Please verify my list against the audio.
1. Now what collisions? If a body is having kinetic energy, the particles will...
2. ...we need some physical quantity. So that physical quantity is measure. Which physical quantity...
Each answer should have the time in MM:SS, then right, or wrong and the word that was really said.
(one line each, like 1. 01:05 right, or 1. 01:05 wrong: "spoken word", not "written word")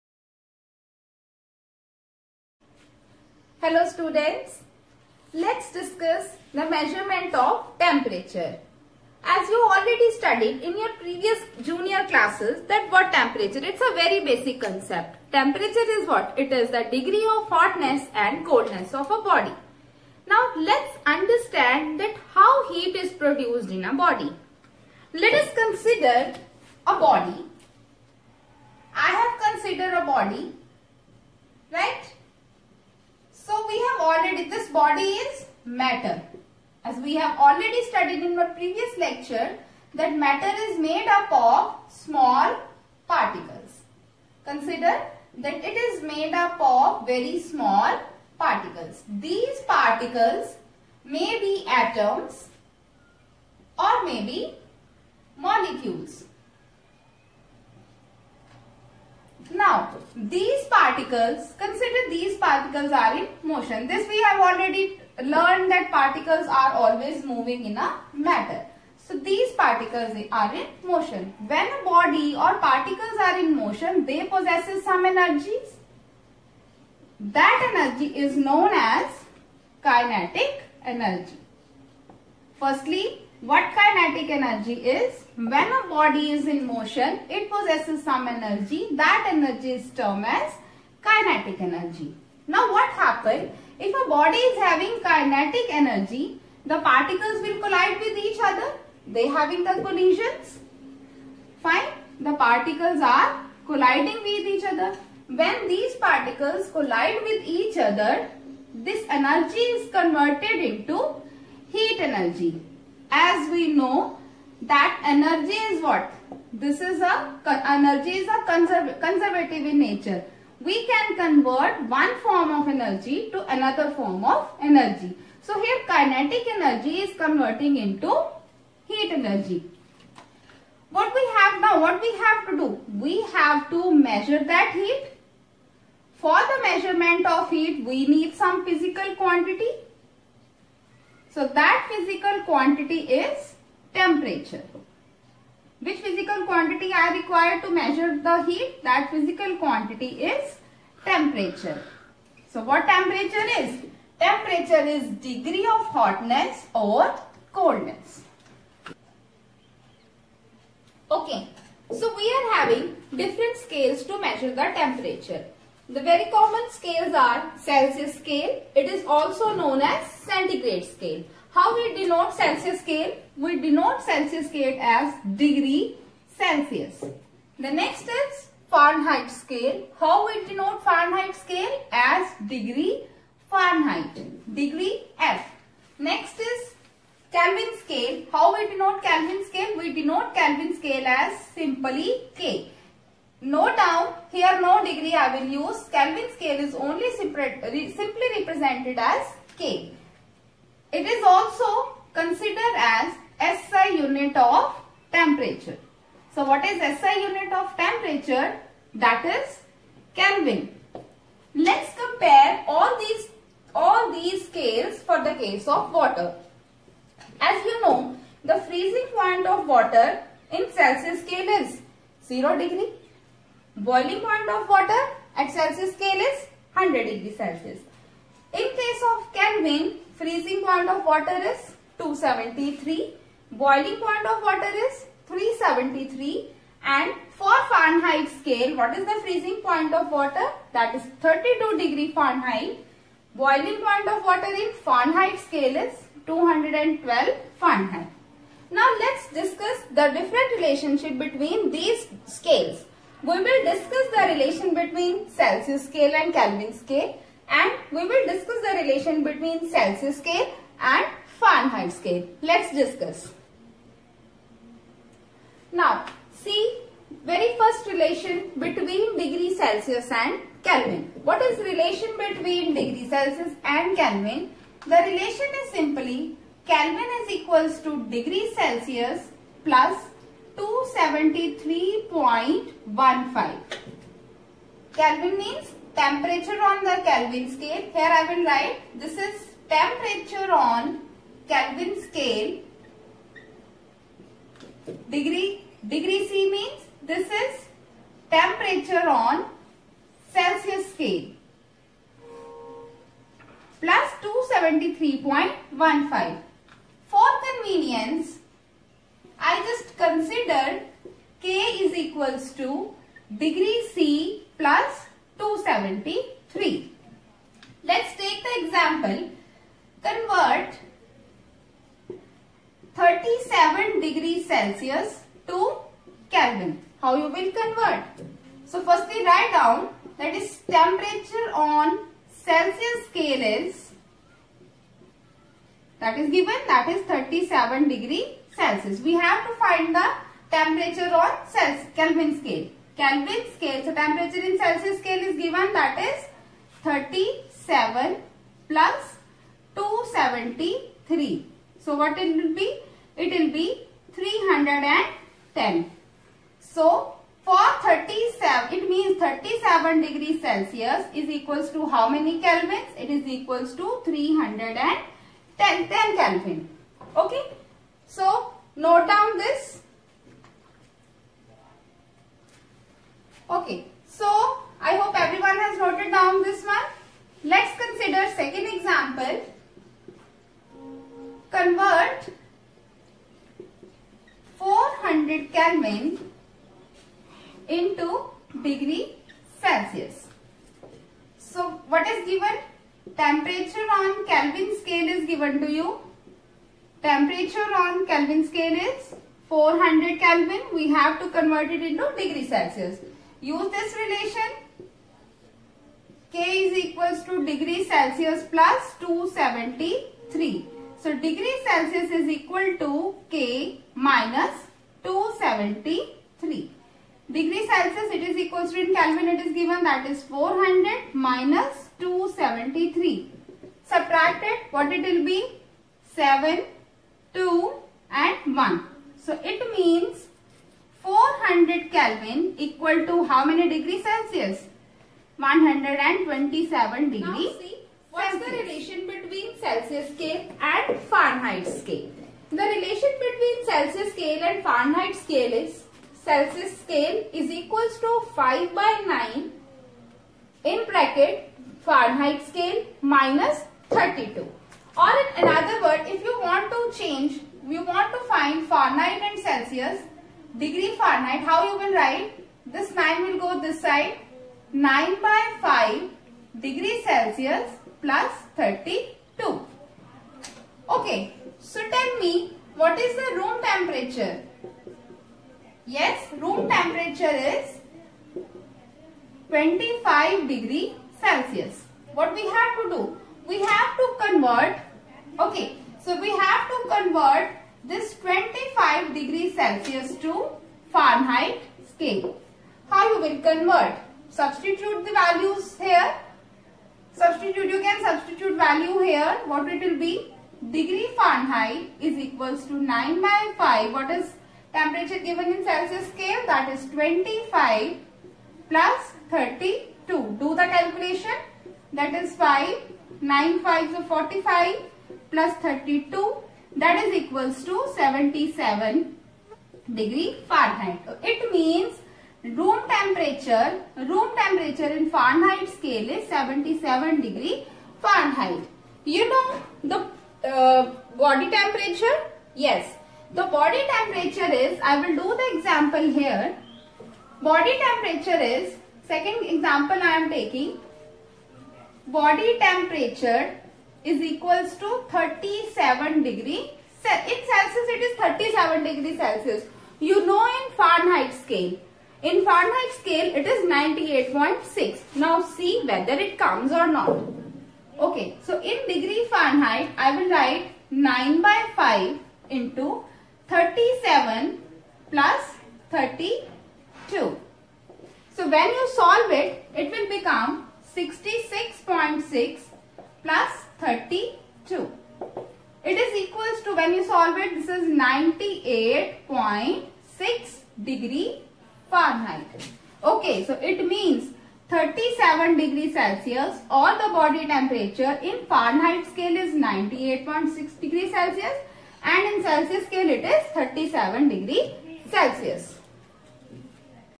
1. 01:32 wrong: "happens", not "collisions"
2. 02:17 wrong: "temperature", not "measure".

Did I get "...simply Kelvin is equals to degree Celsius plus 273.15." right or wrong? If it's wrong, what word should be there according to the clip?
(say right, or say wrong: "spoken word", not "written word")
right.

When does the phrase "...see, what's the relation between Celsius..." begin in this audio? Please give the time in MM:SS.
07:17.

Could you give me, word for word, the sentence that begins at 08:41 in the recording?
It means room temperature, room temperature in Fahrenheit scale is 77 degree Fahrenheit.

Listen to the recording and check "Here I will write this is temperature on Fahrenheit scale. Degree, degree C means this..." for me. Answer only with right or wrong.
wrong.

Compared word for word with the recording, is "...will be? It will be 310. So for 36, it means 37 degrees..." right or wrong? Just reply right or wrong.
wrong.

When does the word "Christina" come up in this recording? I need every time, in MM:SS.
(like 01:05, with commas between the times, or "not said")
not said.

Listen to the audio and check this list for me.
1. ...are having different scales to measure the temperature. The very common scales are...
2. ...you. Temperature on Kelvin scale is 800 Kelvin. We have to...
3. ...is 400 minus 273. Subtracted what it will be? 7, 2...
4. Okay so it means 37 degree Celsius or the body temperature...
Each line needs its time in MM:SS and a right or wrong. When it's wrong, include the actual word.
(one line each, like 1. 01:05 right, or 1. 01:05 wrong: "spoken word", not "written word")
1. 02:42 right
2. 06:35 wrong: "400", not "800"
3. 07:00 right
4. 09:43 right.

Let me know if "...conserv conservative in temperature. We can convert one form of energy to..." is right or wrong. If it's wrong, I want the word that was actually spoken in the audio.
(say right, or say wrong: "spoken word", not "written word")
wrong: "nature", not "temperature".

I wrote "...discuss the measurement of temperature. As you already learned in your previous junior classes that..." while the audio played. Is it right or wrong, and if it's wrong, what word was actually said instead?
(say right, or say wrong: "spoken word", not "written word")
wrong: "studied", not "learned".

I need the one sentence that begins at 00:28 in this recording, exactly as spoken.
I have considered a body, right?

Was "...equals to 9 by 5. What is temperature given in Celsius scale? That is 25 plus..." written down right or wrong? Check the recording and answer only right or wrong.
right.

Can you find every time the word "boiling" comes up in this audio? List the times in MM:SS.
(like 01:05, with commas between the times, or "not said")
03:43, 03:53, 04:03.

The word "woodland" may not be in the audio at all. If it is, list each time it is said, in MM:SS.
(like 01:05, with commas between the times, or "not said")
not said.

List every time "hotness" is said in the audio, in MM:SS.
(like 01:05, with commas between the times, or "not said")
00:17, 02:35.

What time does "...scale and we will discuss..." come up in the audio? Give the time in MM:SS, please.
04:16.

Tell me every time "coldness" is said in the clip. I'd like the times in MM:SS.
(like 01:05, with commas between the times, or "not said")
00:18, 02:37.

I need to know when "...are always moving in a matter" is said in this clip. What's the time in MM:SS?
01:06.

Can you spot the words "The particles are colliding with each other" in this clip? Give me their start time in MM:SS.
01:42.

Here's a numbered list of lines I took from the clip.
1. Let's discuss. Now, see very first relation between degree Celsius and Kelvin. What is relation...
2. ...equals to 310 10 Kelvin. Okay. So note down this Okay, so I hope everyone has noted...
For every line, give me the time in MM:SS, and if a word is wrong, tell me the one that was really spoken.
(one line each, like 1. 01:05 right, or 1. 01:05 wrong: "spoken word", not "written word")
1. 04:22 right
2. 06:03 right.